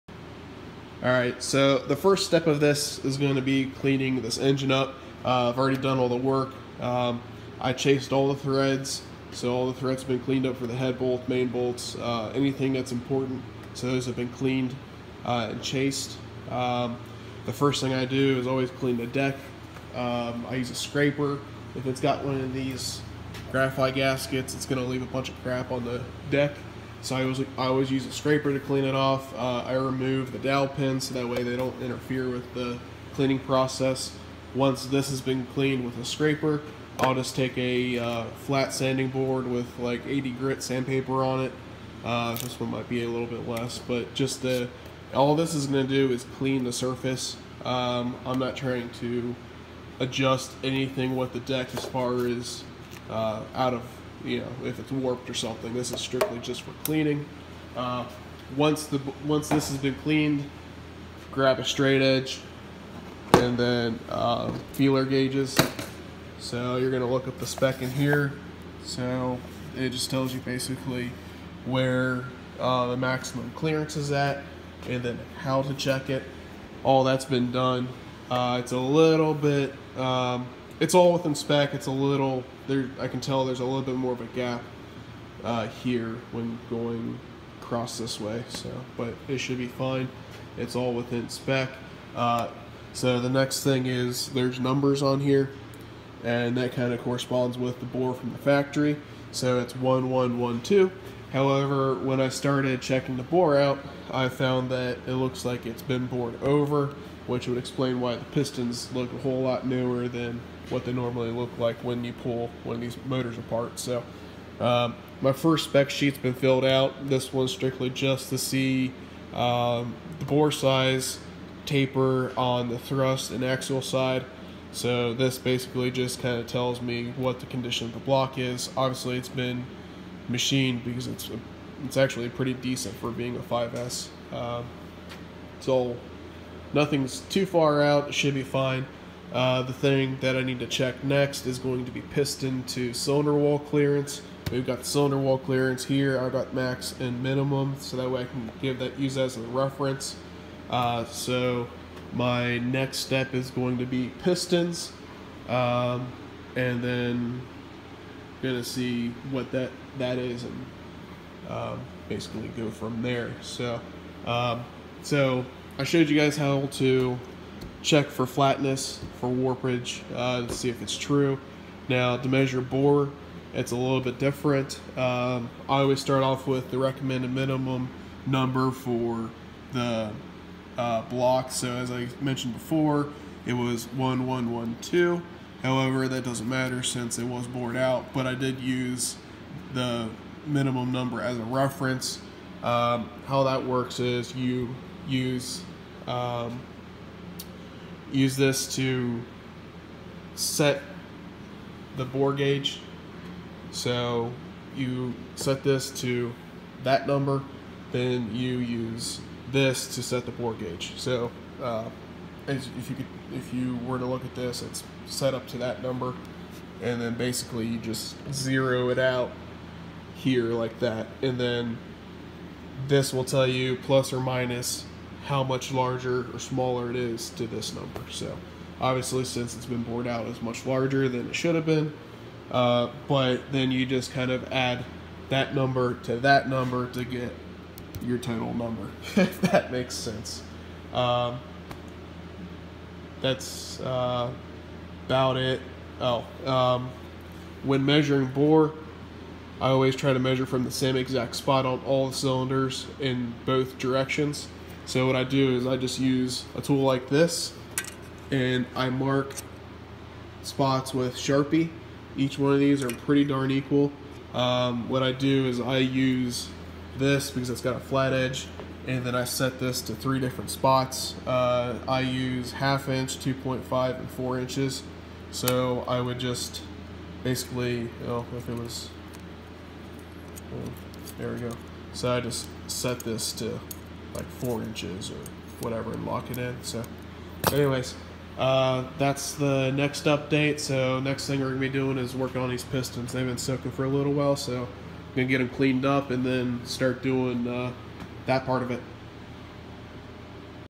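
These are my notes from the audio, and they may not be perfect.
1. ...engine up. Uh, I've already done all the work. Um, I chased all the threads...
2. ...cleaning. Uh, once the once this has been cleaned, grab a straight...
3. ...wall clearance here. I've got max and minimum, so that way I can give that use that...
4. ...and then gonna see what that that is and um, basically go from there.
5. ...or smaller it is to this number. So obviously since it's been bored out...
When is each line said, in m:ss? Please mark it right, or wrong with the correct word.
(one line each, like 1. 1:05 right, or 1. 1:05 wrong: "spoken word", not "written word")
1. 0:04 right
2. 0:56 right
3. 2:25 right
4. 2:36 right
5. 3:46 right.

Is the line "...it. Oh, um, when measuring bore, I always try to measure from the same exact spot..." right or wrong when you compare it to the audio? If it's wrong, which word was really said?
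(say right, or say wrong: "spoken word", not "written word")
right.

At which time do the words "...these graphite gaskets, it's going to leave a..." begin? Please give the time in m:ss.
0:22.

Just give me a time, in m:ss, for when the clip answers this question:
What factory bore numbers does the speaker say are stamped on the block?
1:39.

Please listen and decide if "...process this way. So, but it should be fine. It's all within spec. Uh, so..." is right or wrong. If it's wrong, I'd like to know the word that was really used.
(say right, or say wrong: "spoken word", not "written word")
wrong: "across", not "process".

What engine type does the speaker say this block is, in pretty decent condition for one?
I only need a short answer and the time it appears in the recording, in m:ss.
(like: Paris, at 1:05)
5S, at 2:13.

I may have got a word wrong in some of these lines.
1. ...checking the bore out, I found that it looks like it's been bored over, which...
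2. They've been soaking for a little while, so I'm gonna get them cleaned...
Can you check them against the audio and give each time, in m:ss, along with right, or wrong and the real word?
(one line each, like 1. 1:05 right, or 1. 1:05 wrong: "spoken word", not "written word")
1. 1:42 right
2. 4:53 right.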